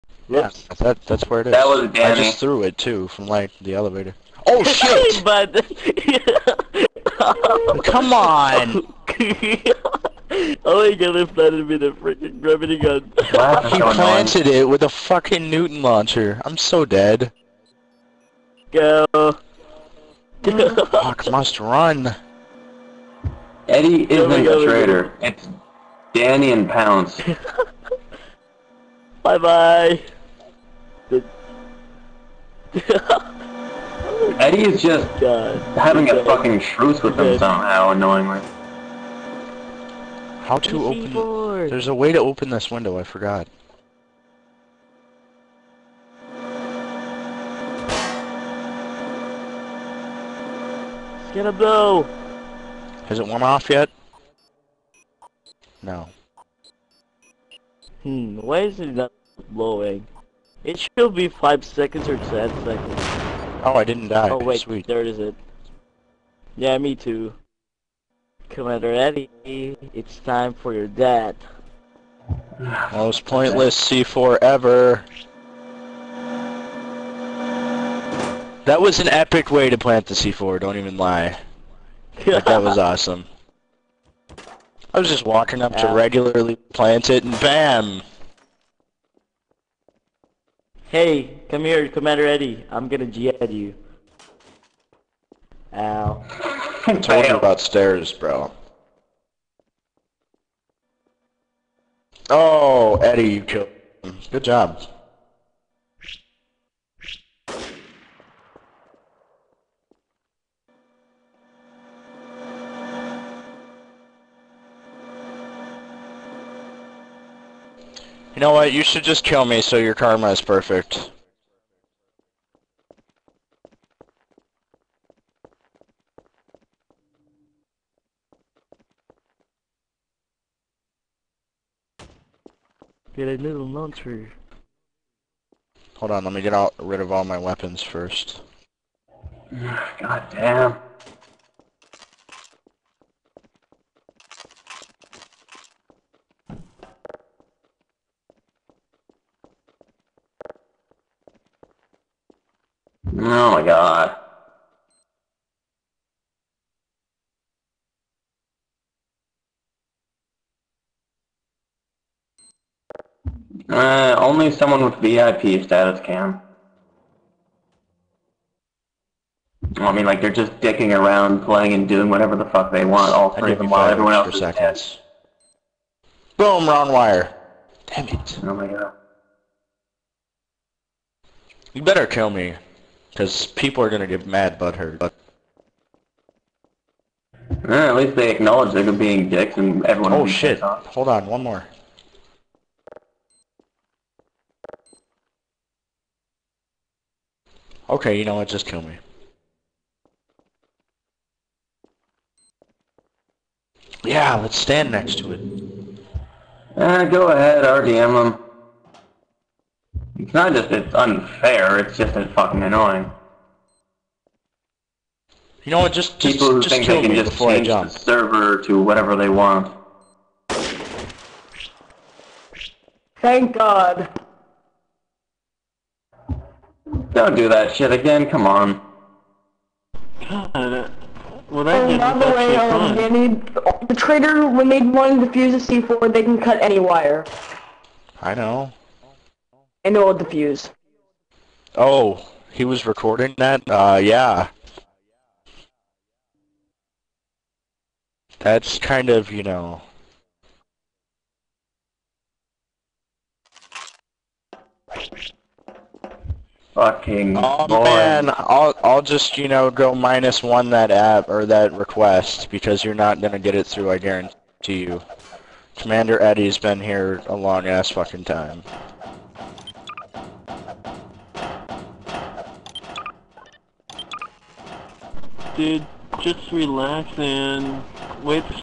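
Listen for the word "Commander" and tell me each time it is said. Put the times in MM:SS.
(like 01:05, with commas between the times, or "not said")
01:08, 01:31, 04:25.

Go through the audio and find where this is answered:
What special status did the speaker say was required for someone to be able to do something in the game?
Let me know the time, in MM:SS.
02:44.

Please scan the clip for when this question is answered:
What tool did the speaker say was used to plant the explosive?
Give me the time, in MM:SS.
00:15.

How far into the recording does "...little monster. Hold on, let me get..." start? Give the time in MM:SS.
02:13.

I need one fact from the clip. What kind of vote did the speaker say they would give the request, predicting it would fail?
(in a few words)
minus one.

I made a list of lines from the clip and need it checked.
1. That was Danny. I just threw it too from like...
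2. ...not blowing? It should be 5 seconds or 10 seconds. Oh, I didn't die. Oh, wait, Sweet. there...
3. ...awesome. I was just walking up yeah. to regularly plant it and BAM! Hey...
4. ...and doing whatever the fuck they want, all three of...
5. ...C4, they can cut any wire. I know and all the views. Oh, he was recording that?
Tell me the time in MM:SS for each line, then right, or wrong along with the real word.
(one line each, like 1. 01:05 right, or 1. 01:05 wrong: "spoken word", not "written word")
1. 00:01 right
2. 00:58 right
3. 01:22 right
4. 02:51 right
5. 03:55 right.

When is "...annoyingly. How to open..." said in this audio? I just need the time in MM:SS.
00:37.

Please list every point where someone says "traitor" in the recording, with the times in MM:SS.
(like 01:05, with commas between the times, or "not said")
00:24, 03:53.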